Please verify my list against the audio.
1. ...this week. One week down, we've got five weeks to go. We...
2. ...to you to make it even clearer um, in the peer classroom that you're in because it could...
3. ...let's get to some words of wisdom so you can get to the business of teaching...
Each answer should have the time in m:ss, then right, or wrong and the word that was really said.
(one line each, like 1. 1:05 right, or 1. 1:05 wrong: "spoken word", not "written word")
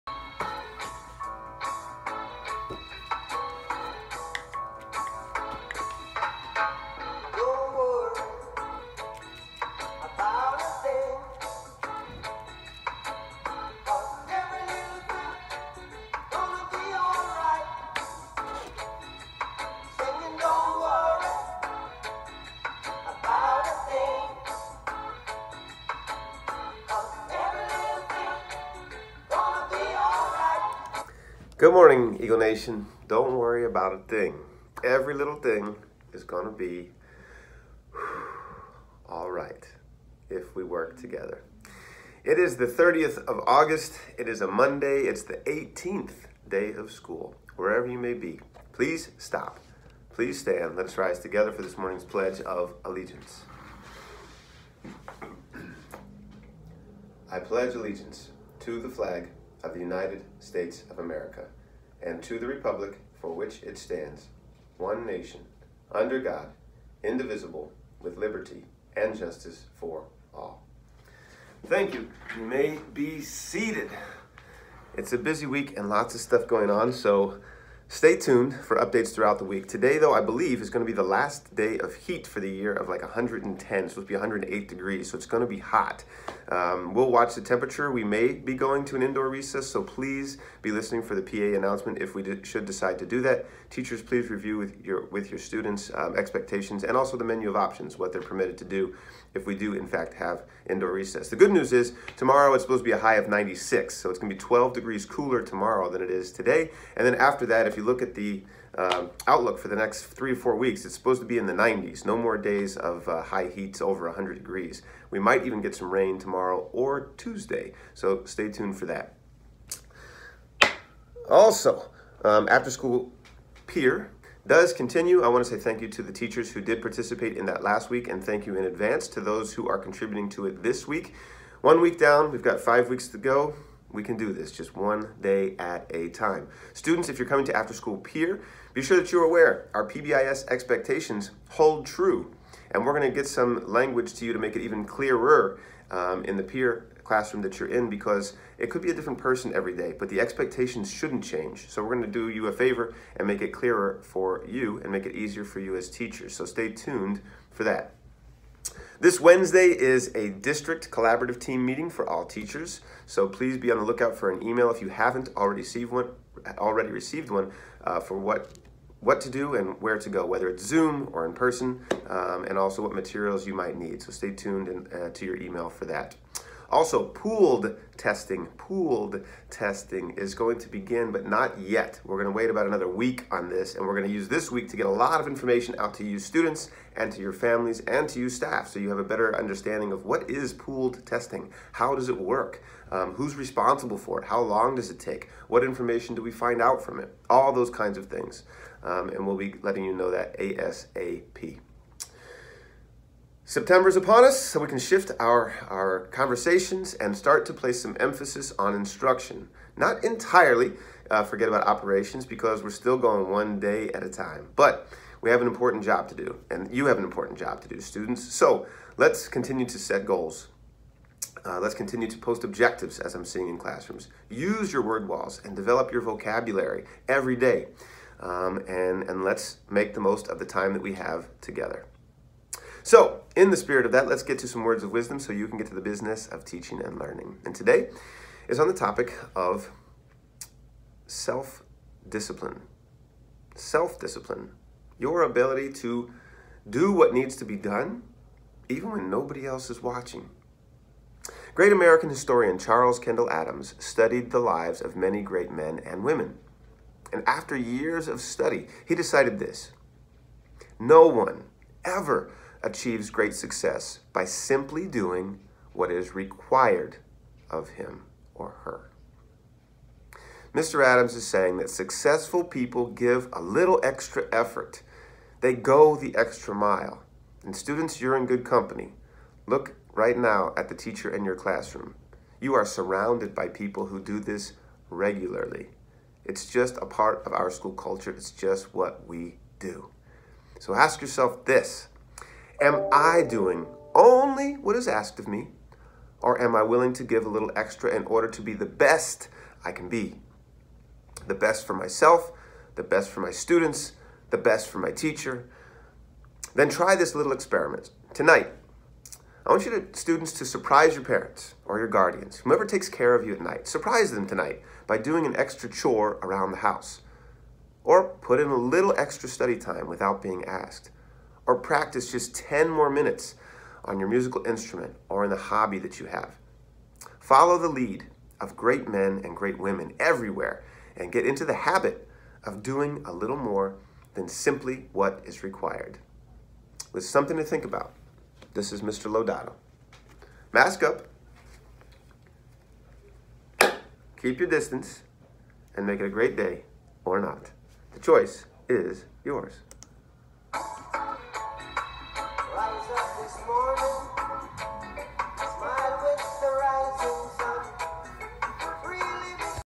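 1. 2:10 right
2. 2:24 right
3. 3:54 right.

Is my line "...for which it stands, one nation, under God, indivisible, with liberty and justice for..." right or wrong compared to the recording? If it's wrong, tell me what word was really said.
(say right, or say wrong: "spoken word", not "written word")
right.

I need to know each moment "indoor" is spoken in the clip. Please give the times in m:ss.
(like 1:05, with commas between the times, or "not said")
1:29, 1:40.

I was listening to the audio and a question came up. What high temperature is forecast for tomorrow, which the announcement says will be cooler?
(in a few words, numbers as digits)
96.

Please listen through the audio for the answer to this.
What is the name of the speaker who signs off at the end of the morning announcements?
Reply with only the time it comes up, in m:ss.
5:38.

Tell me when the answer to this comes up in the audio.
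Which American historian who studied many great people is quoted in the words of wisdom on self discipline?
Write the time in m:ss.
4:12.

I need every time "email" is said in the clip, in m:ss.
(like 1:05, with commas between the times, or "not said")
2:44, 2:55.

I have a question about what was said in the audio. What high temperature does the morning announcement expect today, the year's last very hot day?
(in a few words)
108 degrees.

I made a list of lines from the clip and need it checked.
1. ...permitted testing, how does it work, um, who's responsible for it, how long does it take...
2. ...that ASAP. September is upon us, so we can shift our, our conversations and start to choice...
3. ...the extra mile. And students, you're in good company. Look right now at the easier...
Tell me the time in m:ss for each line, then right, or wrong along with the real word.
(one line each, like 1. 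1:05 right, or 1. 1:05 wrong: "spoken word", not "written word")
1. 3:10 wrong: "pooled", not "permitted"
2. 3:20 wrong: "place", not "choice"
3. 4:35 wrong: "teacher", not "easier".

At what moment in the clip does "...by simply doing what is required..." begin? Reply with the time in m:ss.
4:24.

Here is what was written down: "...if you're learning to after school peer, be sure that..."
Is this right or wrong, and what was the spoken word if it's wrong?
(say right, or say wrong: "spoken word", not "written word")
wrong: "coming", not "learning".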